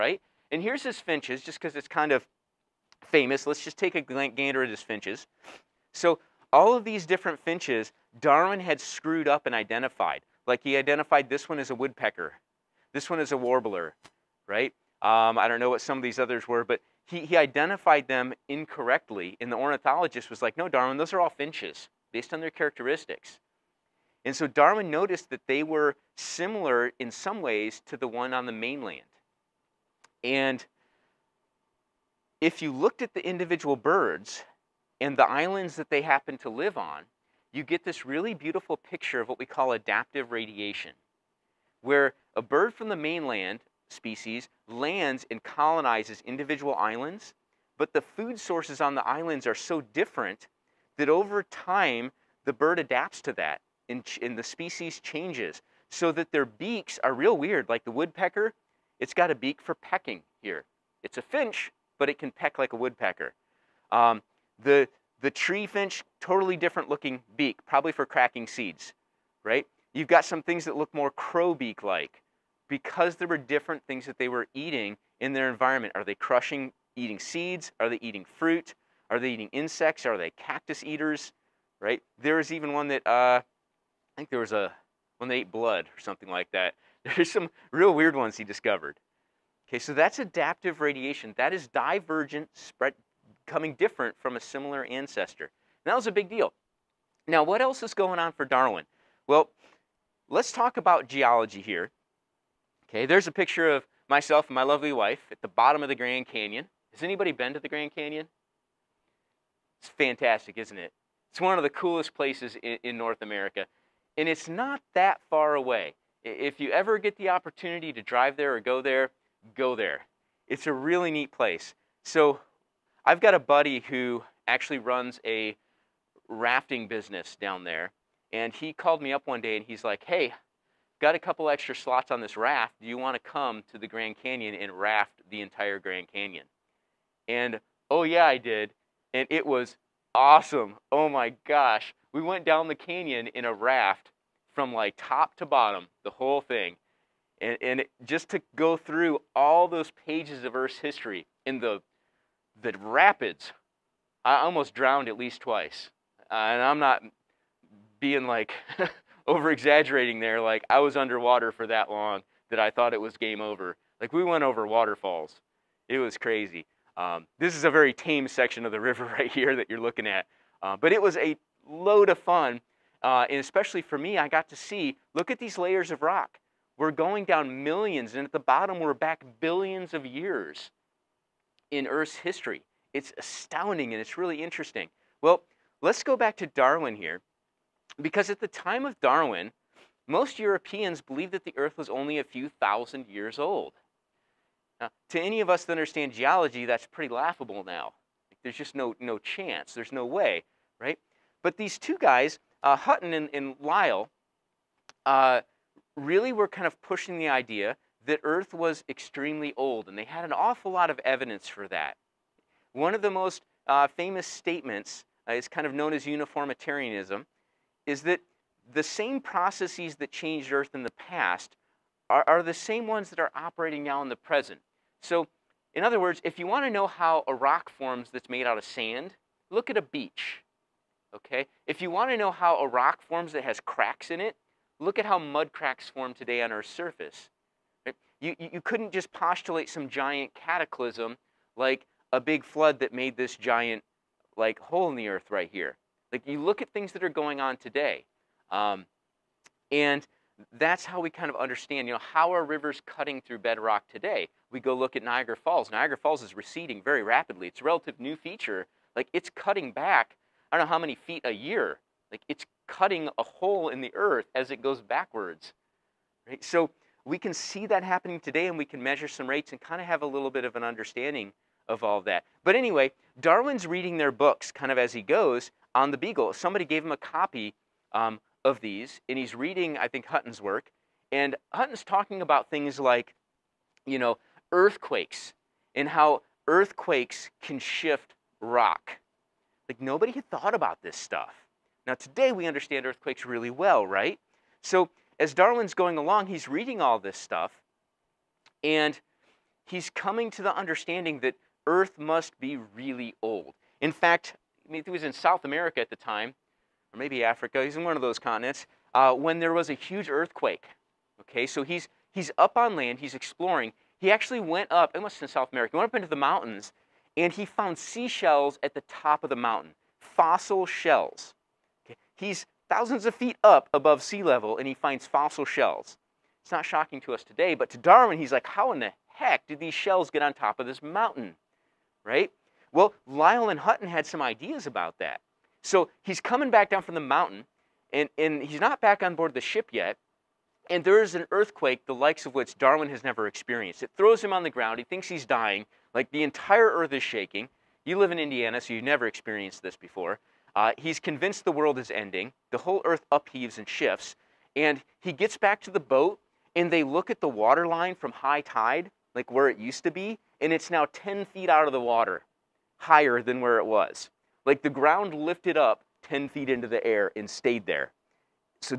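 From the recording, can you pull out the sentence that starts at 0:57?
Like the woodpecker, it's got a beak for pecking here.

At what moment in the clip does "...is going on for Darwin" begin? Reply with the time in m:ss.
1:37.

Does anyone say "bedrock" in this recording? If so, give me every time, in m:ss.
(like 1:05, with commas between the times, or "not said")
4:13.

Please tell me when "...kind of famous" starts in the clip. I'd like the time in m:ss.
0:01.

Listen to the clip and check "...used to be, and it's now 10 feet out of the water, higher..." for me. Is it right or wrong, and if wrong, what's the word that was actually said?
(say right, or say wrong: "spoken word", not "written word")
right.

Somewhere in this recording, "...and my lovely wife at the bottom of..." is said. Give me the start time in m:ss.
1:44.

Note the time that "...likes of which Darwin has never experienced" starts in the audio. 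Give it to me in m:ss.
5:41.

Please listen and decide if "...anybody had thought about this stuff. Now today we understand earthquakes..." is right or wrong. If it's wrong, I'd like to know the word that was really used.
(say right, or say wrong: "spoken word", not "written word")
wrong: "nobody", not "anybody".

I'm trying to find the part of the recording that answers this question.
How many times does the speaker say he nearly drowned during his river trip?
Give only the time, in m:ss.
2:35.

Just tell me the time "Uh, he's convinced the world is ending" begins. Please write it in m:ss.
5:50.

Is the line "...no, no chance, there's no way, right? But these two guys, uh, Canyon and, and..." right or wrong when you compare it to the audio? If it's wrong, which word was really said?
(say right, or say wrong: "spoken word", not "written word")
wrong: "Hutton", not "Canyon".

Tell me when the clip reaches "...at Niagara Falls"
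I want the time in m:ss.
4:14.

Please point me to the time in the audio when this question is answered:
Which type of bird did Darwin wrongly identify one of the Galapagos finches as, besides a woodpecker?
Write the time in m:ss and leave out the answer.
0:13.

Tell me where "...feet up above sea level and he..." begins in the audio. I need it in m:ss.
5:23.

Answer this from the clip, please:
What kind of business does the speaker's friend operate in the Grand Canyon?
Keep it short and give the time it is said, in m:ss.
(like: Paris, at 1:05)
Rafting business, at 2:06.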